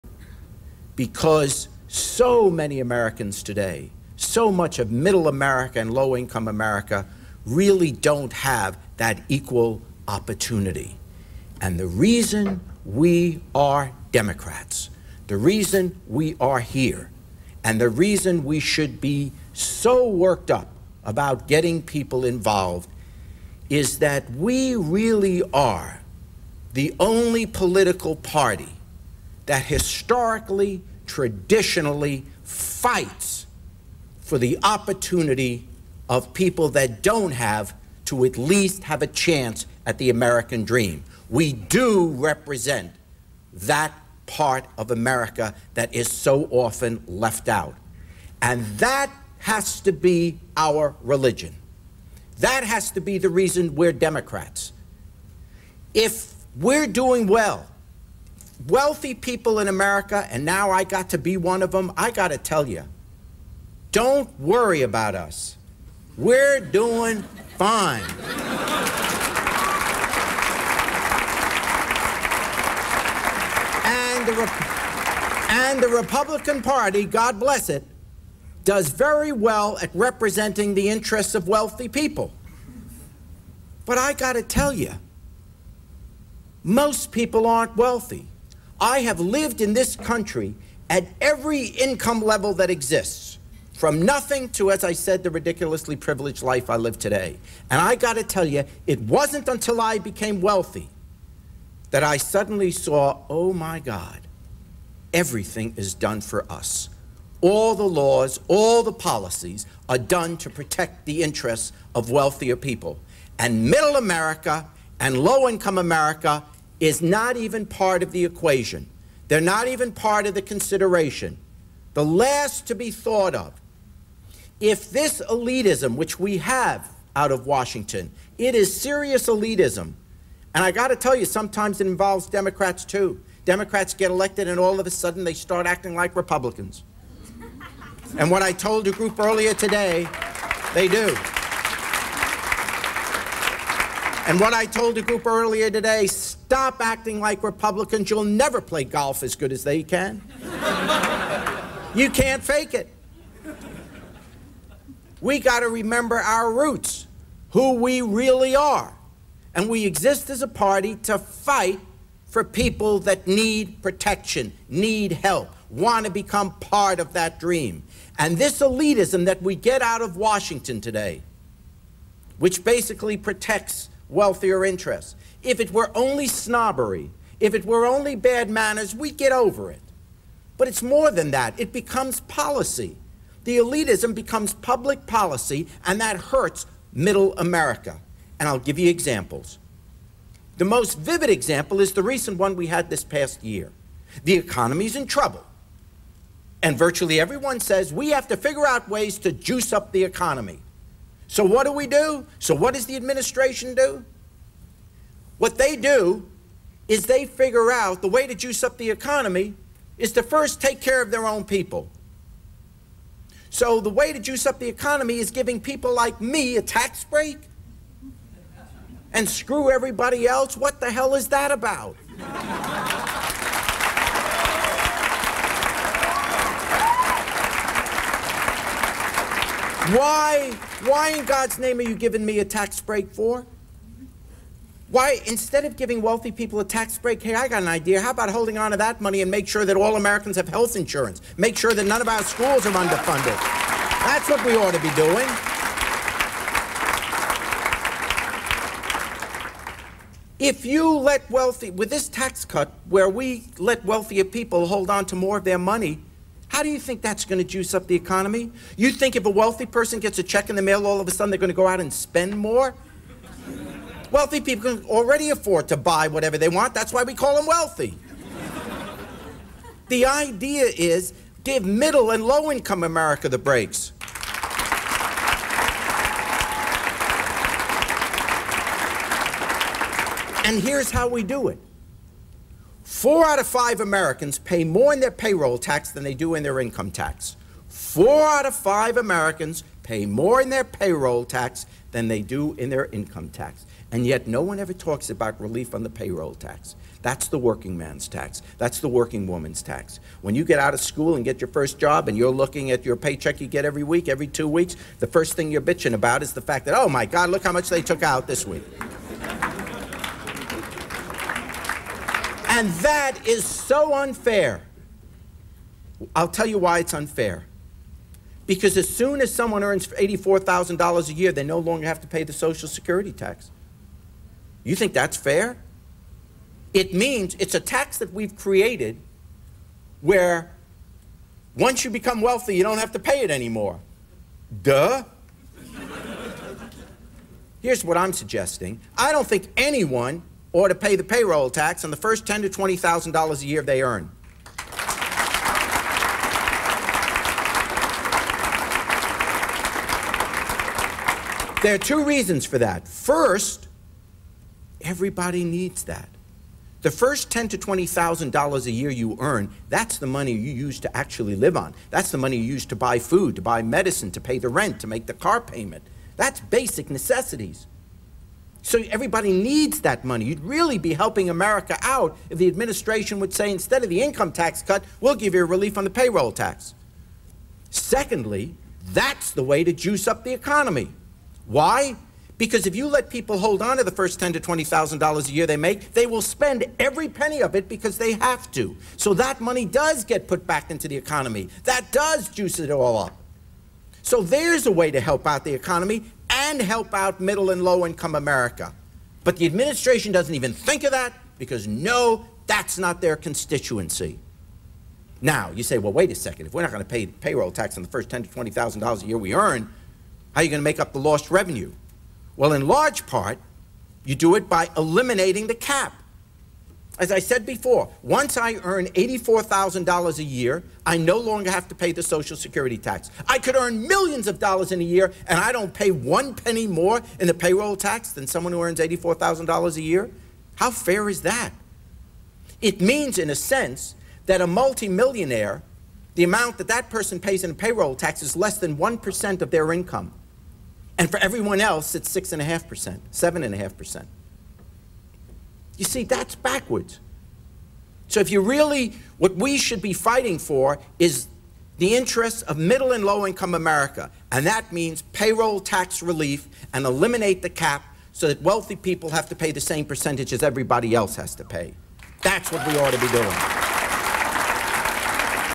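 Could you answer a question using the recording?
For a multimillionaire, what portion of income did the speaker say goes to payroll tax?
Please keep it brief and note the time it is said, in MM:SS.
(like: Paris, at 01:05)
Less than 1%, at 07:18.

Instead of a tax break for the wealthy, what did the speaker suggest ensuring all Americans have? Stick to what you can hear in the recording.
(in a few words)
Health insurance.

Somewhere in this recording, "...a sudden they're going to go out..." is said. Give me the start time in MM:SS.
04:21.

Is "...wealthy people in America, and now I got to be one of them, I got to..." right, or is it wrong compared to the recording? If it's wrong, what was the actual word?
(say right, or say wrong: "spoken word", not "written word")
right.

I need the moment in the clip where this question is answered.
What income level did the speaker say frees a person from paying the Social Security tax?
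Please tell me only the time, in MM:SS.
05:19.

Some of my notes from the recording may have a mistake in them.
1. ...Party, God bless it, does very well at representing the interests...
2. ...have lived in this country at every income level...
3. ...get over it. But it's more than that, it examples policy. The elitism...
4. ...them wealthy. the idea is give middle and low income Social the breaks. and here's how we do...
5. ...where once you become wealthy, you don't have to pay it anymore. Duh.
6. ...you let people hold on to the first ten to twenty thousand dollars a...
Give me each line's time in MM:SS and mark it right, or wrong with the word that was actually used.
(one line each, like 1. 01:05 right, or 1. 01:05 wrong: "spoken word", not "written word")
1. 01:16 right
2. 01:29 right
3. 02:59 wrong: "becomes", not "examples"
4. 04:27 wrong: "America", not "Social"
5. 05:30 right
6. 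06:22 right.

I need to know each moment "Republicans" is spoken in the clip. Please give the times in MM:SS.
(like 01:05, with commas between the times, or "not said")
01:15, 02:16, 02:27.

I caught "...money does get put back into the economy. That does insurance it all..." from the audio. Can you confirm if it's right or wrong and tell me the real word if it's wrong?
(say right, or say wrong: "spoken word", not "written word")
wrong: "juice", not "insurance".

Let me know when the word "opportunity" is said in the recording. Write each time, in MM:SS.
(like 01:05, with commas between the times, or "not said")
00:10, 00:34.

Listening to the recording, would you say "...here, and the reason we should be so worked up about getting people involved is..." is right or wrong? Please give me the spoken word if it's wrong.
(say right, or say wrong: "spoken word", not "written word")
right.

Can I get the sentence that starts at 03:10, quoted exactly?
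The most vivid example is the recent one we had this past year.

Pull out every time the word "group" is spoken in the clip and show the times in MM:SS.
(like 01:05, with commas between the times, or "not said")
02:18, 02:25.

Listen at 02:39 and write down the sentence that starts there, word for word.
And we exist as a party to fight for people that need protection, need help, want to become part of that dream.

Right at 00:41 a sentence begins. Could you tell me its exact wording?
We do represent that part of America that is so often left out.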